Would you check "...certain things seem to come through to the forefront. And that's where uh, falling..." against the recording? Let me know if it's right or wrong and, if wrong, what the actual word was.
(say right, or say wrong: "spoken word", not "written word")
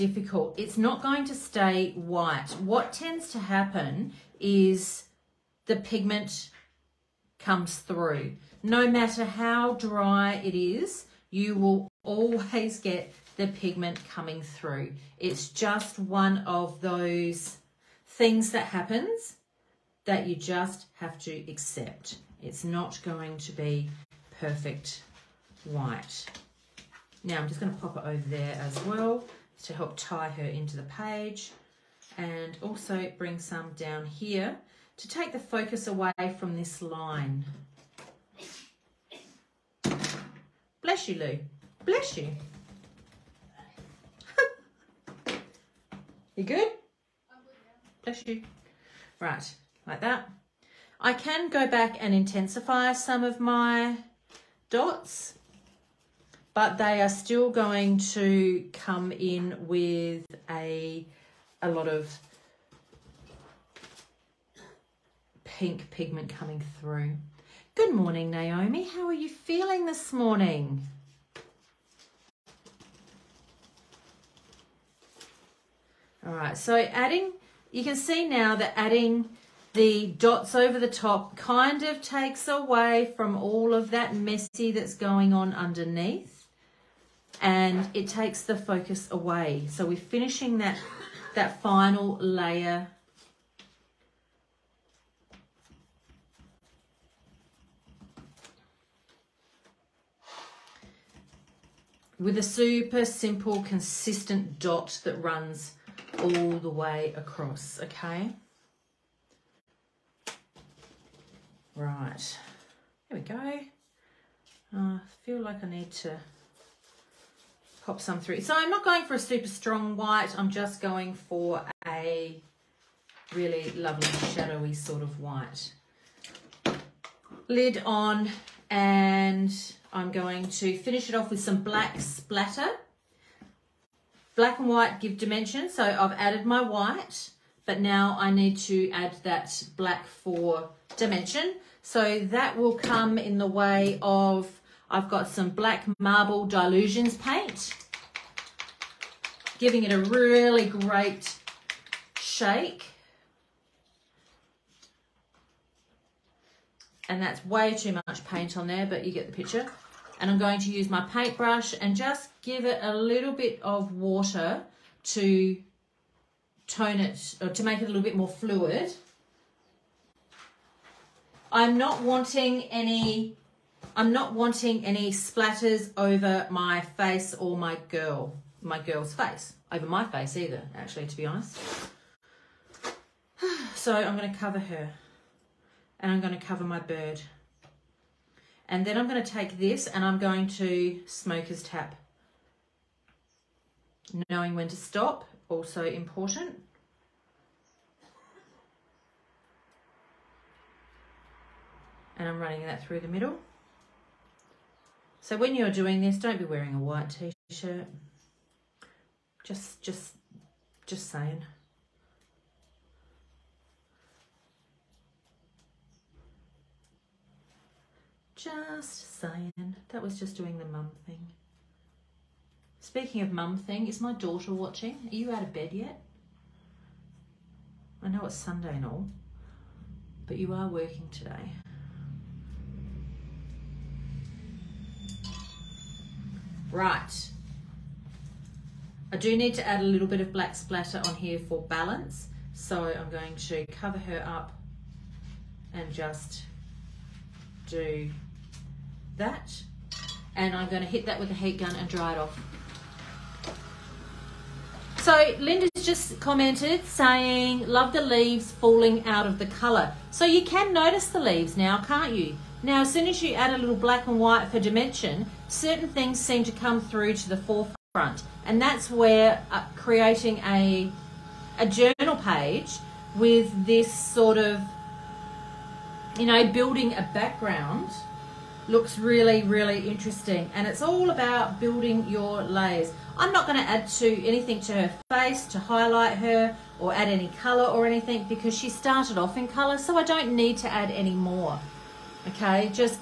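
wrong: "creating", not "falling".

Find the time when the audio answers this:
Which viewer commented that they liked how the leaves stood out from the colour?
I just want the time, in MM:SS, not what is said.
04:15.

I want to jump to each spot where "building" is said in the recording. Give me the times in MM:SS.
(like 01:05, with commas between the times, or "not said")
04:36, 04:41.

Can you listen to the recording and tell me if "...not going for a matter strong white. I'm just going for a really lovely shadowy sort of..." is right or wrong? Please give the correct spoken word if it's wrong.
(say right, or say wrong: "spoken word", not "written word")
wrong: "super", not "matter".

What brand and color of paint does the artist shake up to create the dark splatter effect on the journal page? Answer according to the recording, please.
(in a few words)
Black marble Dylusions.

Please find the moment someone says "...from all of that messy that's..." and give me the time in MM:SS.
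01:23.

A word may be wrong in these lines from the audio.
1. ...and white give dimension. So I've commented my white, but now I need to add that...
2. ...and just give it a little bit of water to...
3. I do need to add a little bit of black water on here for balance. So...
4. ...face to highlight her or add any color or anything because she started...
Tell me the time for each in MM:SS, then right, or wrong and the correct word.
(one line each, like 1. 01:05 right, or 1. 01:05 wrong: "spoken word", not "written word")
1. 02:14 wrong: "added", not "commented"
2. 02:41 right
3. 03:59 wrong: "splatter", not "water"
4. 04:45 right.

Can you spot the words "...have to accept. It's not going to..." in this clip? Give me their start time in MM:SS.
00:20.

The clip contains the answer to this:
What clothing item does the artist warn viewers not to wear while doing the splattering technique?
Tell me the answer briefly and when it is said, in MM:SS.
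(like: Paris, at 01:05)
White t-shirt, at 03:26.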